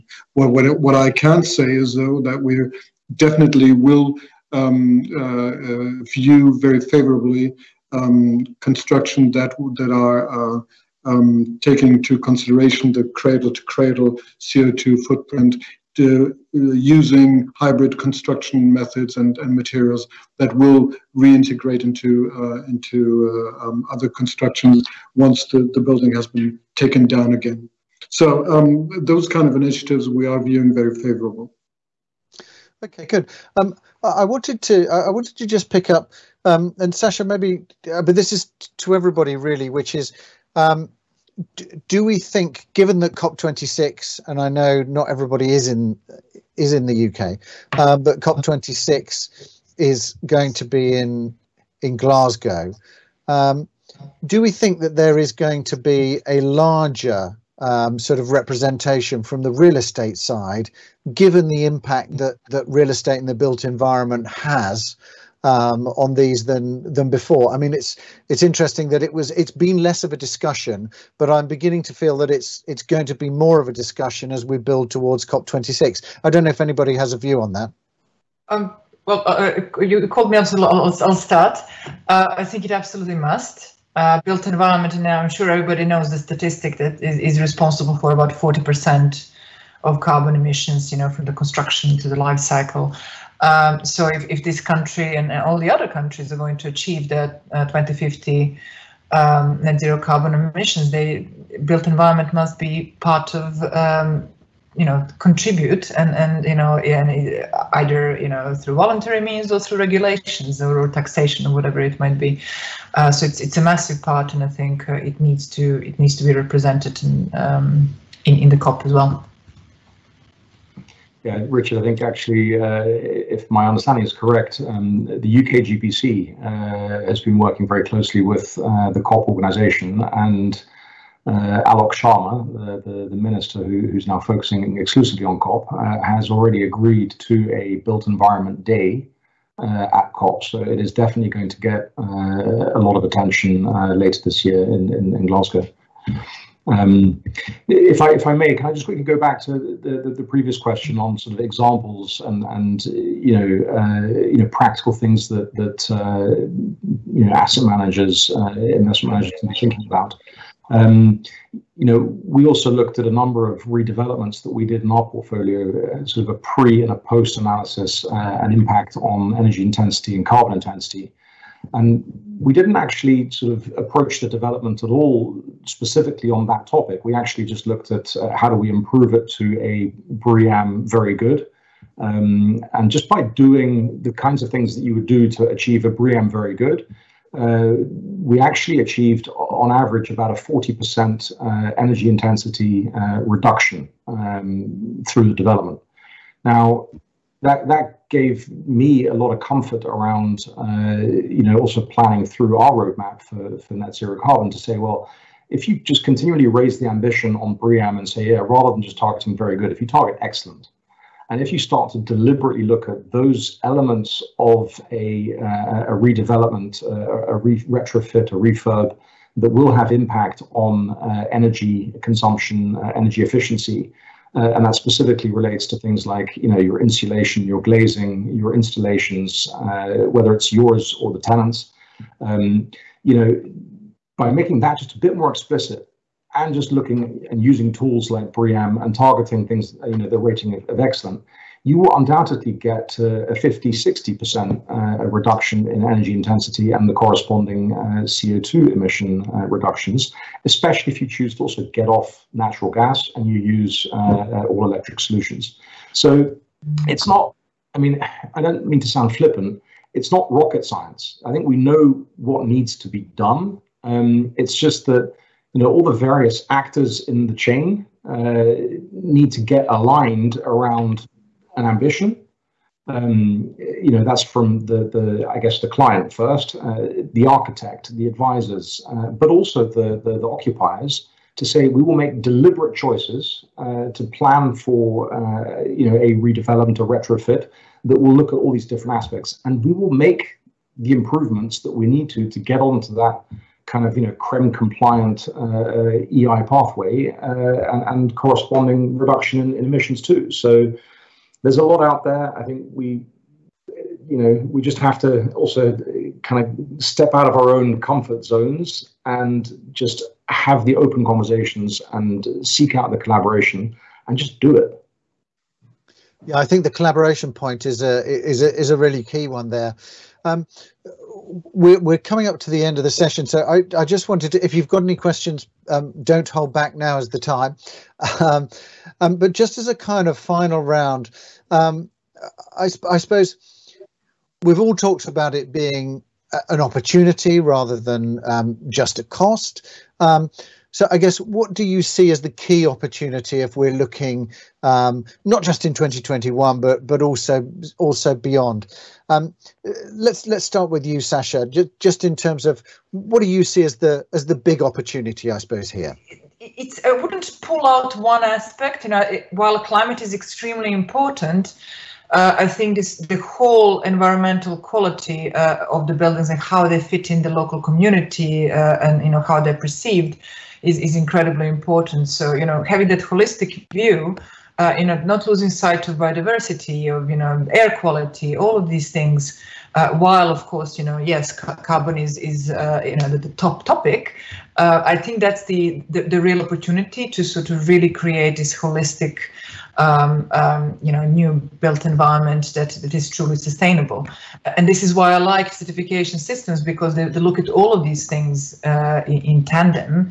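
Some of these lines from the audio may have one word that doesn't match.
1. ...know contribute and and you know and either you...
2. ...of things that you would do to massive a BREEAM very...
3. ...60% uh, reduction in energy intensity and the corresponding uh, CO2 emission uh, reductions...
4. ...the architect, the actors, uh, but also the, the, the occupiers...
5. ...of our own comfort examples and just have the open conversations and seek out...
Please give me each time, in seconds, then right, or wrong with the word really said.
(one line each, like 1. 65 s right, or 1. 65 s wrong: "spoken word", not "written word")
1. 104 s right
2. 184 s wrong: "achieve", not "massive"
3. 243 s right
4. 277 s wrong: "advisors", not "actors"
5. 307 s wrong: "zones", not "examples".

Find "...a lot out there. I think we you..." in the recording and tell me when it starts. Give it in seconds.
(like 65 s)
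301 s.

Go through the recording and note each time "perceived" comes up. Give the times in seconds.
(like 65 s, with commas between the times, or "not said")
369 s.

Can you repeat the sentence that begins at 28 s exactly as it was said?
So um, those kind of initiatives we are viewing very favorable.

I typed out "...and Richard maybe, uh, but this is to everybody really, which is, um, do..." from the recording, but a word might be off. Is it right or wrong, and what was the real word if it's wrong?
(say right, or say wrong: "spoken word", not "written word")
wrong: "Sasha", not "Richard".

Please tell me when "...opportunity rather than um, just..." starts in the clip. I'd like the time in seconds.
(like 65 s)
336 s.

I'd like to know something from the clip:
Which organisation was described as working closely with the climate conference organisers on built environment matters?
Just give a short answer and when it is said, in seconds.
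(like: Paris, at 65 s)
UK GBC, at 125 s.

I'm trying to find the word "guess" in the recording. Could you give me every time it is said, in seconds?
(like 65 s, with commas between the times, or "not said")
275 s, 340 s.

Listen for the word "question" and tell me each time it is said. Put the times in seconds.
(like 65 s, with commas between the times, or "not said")
150 s, 324 s.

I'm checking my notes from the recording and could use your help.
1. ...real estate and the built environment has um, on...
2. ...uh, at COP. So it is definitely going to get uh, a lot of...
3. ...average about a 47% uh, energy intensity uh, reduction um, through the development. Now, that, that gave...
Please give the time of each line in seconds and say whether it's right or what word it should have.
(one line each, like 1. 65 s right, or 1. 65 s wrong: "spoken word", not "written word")
1. 62 s right
2. 139 s right
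3. 189 s wrong: "40", not "47".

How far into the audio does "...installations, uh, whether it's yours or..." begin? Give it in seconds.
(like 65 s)
228 s.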